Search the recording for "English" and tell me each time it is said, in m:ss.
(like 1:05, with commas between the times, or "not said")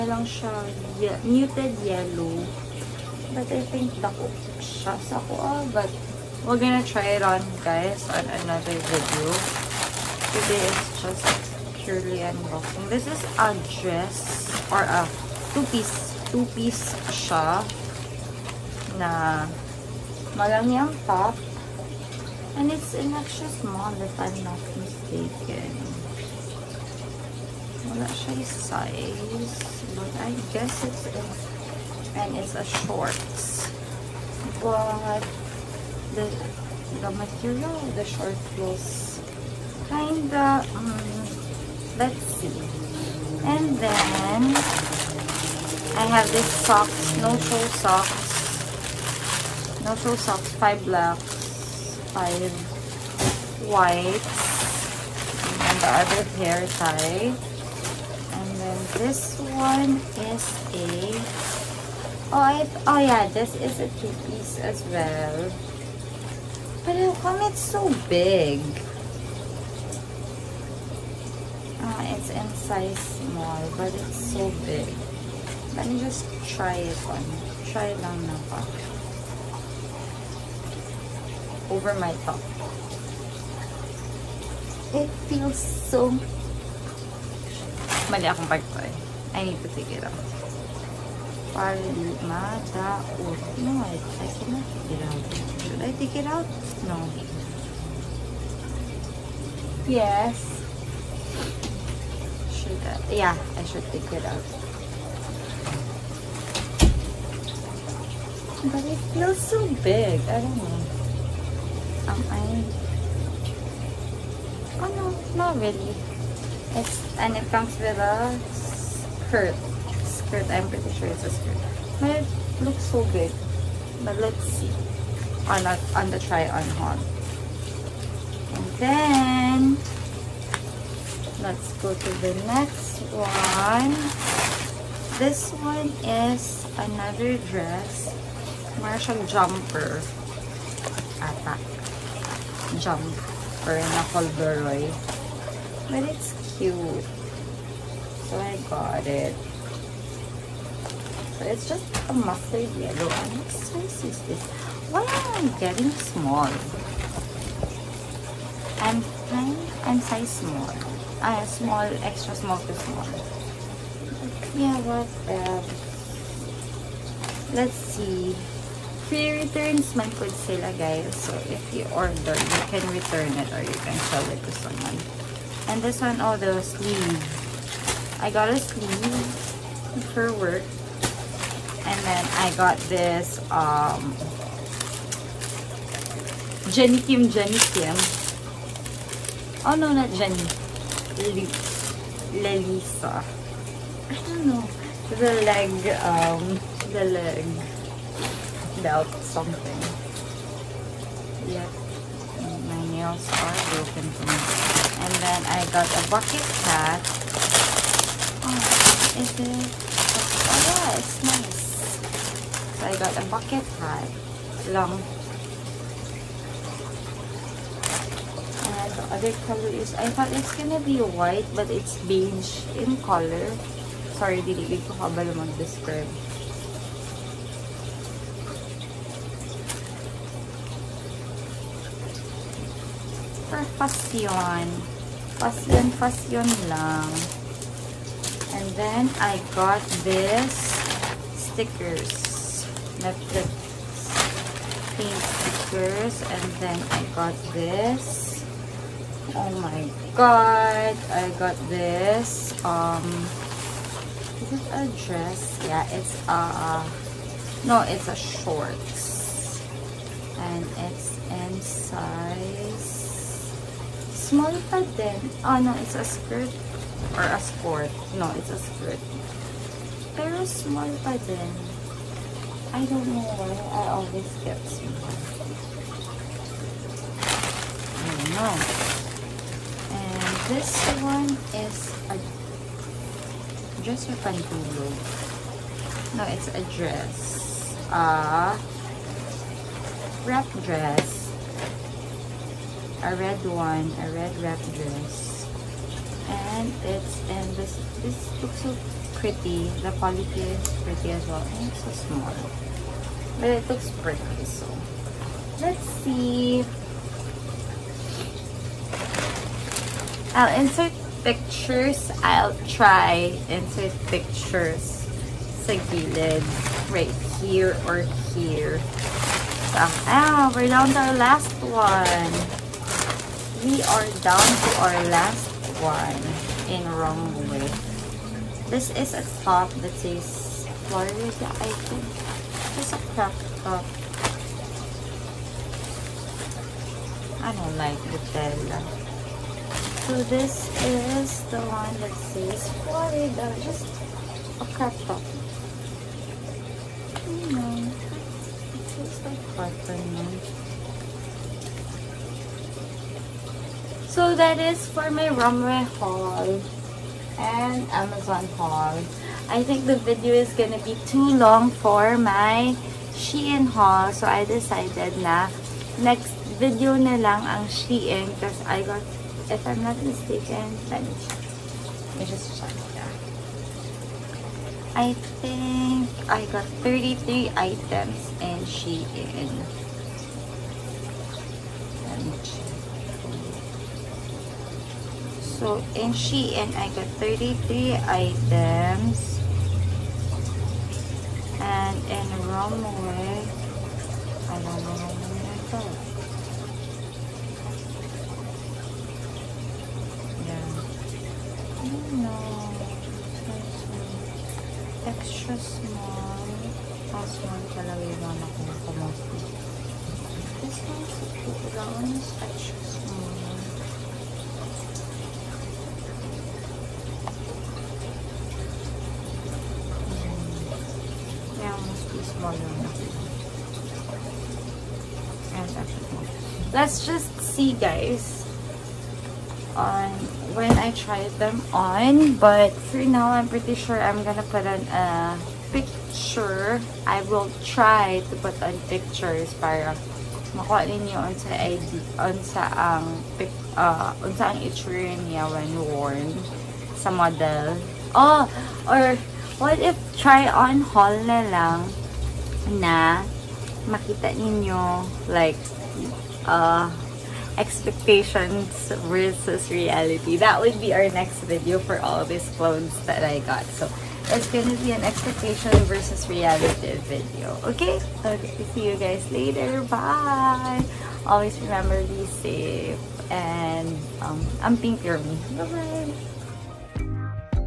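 not said.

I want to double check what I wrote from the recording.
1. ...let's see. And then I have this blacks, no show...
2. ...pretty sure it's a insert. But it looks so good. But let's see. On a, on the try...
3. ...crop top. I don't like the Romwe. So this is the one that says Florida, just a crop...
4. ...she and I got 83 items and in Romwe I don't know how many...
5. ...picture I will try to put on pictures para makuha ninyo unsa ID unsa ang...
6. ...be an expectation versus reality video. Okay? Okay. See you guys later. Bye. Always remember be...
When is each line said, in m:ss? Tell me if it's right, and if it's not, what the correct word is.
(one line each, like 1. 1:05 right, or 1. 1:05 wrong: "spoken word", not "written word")
1. 0:41 wrong: "socks", not "blacks"
2. 2:00 wrong: "skirt", not "insert"
3. 5:33 wrong: "Nutella", not "Romwe"
4. 6:26 wrong: "33", not "83"
5. 7:15 right
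6. 7:44 right.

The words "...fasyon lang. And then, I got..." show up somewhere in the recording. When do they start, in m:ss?
3:55.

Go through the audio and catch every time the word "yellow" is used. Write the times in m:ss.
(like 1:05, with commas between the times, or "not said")
0:01, 2:32.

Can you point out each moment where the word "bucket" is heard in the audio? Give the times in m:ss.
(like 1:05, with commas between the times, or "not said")
3:26, 3:33.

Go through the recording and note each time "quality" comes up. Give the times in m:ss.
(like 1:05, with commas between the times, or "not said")
4:59.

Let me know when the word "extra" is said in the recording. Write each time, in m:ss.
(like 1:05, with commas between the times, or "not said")
0:23, 2:42, 6:45, 6:52.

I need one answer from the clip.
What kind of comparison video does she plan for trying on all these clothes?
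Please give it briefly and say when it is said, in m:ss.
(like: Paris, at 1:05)
expectations versus reality, at 7:37.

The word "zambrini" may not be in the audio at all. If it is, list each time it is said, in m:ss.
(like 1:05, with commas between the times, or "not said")
not said.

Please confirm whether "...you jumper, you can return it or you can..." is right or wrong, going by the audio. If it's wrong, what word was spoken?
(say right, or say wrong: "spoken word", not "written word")
wrong: "order", not "jumper".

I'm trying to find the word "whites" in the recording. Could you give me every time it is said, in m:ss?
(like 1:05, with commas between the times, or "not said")
0:53, 3:41.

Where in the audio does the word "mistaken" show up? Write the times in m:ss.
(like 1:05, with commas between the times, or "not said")
0:24, 6:10.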